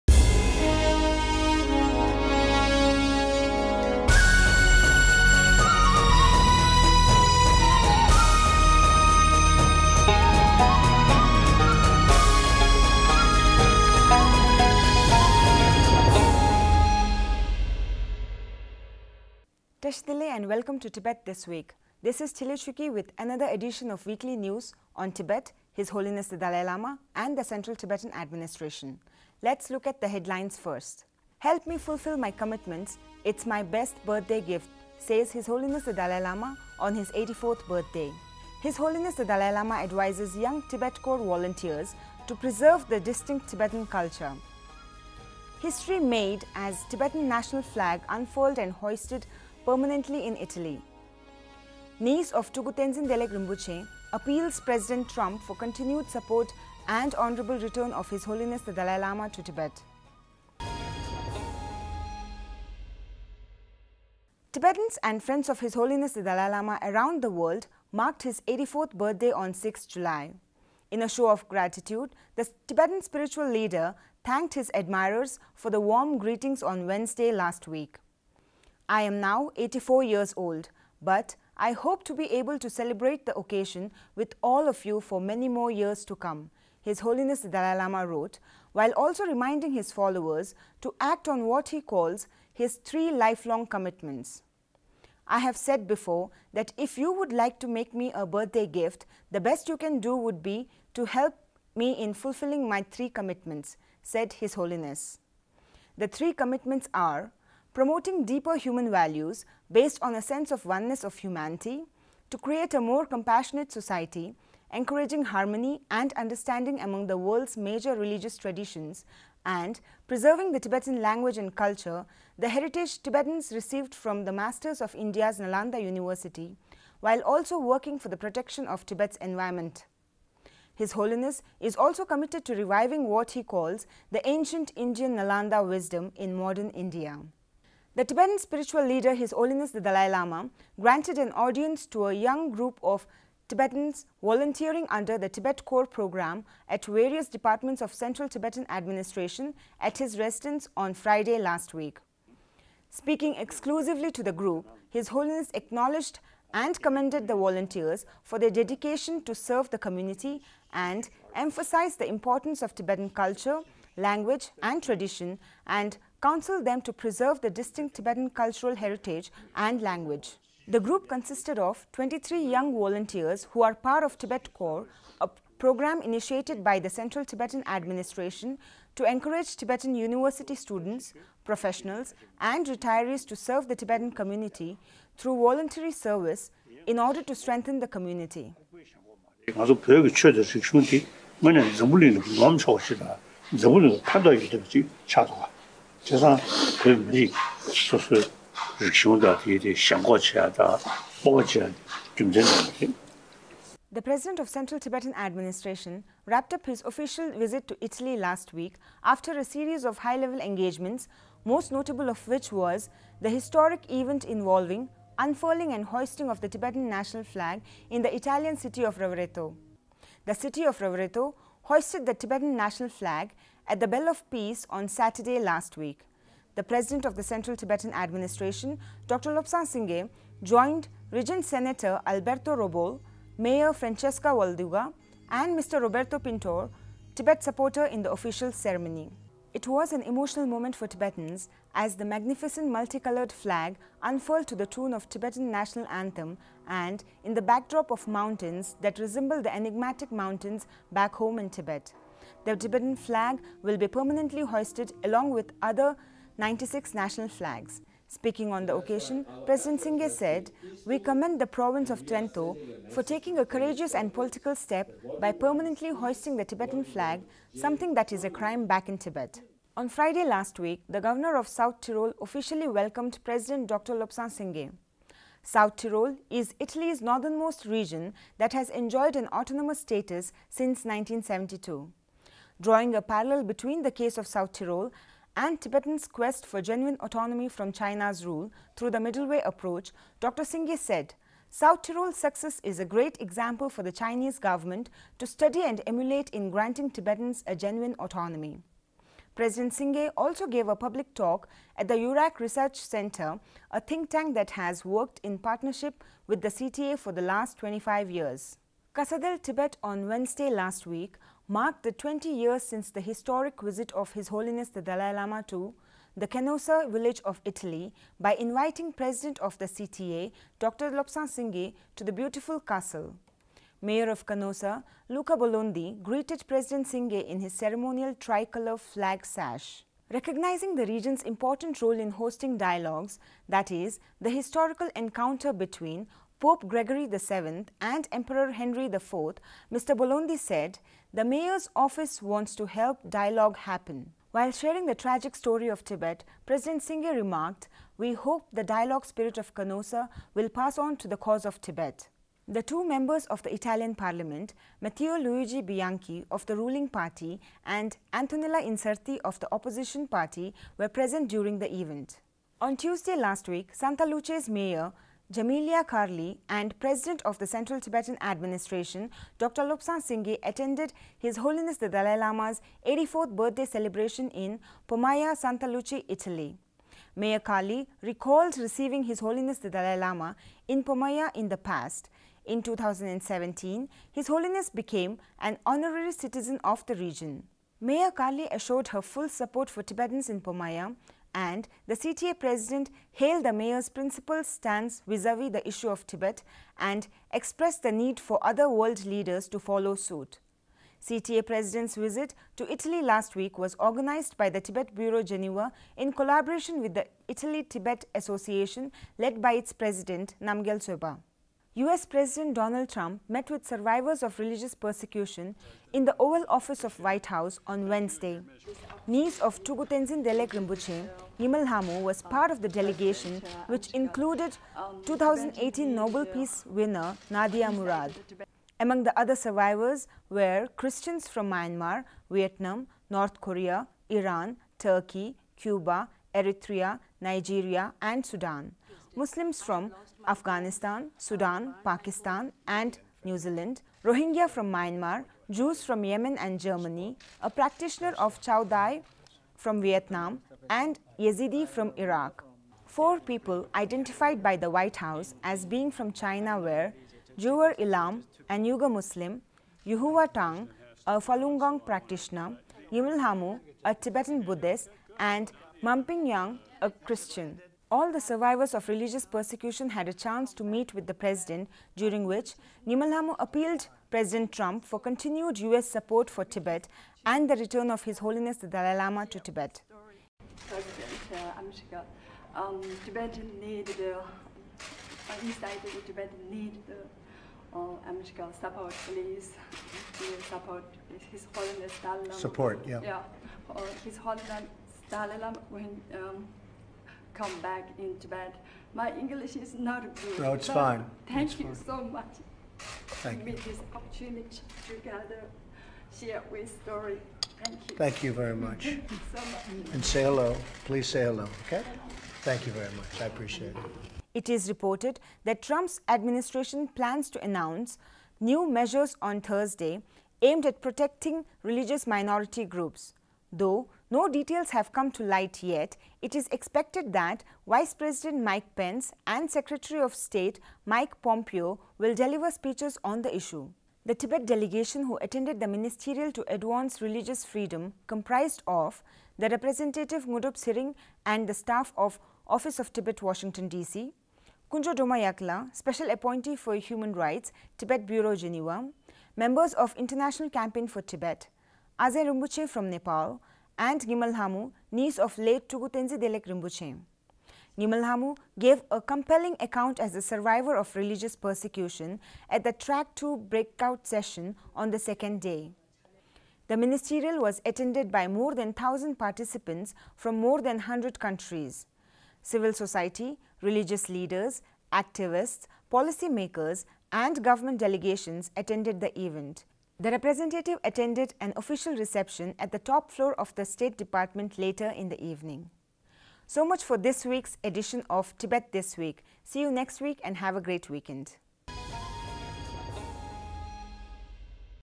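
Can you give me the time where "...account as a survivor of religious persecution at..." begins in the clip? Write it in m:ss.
9:19.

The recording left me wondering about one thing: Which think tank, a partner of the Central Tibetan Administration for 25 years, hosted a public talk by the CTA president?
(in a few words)
Eurac Research Center.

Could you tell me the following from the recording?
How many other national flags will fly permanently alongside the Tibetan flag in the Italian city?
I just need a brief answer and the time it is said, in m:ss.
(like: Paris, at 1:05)
96, at 4:16.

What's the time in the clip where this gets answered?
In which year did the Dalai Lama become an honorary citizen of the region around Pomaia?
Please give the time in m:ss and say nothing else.
6:22.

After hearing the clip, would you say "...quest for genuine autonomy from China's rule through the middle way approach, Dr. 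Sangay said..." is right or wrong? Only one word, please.
right.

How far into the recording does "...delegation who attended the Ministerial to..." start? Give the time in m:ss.
8:54.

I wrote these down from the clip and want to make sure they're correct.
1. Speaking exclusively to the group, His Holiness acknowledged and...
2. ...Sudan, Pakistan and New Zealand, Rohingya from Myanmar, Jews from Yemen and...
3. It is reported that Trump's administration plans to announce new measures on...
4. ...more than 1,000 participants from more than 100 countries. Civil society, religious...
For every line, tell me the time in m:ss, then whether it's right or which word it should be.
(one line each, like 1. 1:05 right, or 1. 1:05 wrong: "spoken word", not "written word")
1. 2:32 right
2. 7:21 right
3. 8:34 right
4. 9:28 right.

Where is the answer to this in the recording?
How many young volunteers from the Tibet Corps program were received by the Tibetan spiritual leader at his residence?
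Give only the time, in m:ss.
2:51.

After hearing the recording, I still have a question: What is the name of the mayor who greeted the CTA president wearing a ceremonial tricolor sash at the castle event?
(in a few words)
Luca Bolondi.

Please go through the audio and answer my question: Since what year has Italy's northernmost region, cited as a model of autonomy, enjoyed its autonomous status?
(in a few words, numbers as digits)
1972.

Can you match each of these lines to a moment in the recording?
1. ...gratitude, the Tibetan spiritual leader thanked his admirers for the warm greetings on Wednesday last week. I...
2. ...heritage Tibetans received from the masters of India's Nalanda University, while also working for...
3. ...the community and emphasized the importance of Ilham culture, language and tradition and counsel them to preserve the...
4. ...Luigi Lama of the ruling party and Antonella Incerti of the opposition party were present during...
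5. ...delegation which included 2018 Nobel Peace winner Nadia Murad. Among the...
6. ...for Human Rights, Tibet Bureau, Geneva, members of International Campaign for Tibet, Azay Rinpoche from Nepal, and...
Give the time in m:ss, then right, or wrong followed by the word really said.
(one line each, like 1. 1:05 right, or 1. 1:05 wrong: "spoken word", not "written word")
1. 1:11 right
2. 2:02 right
3. 2:39 wrong: "Tibetan", not "Ilham"
4. 5:55 wrong: "Bianchi", not "Lama"
5. 7:02 right
6. 9:06 right.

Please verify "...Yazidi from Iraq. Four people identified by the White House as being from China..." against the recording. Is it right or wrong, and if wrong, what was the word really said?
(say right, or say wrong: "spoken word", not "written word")
right.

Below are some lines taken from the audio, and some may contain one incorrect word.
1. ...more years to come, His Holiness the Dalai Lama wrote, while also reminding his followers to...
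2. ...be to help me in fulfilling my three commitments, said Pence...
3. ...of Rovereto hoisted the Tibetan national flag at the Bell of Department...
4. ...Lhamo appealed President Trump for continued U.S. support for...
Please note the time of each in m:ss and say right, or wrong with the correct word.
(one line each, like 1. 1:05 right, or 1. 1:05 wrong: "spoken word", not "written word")
1. 1:25 right
2. 1:40 wrong: "His", not "Pence"
3. 3:40 wrong: "Peace", not "Department"
4. 7:53 right.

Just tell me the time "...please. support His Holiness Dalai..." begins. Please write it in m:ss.
8:09.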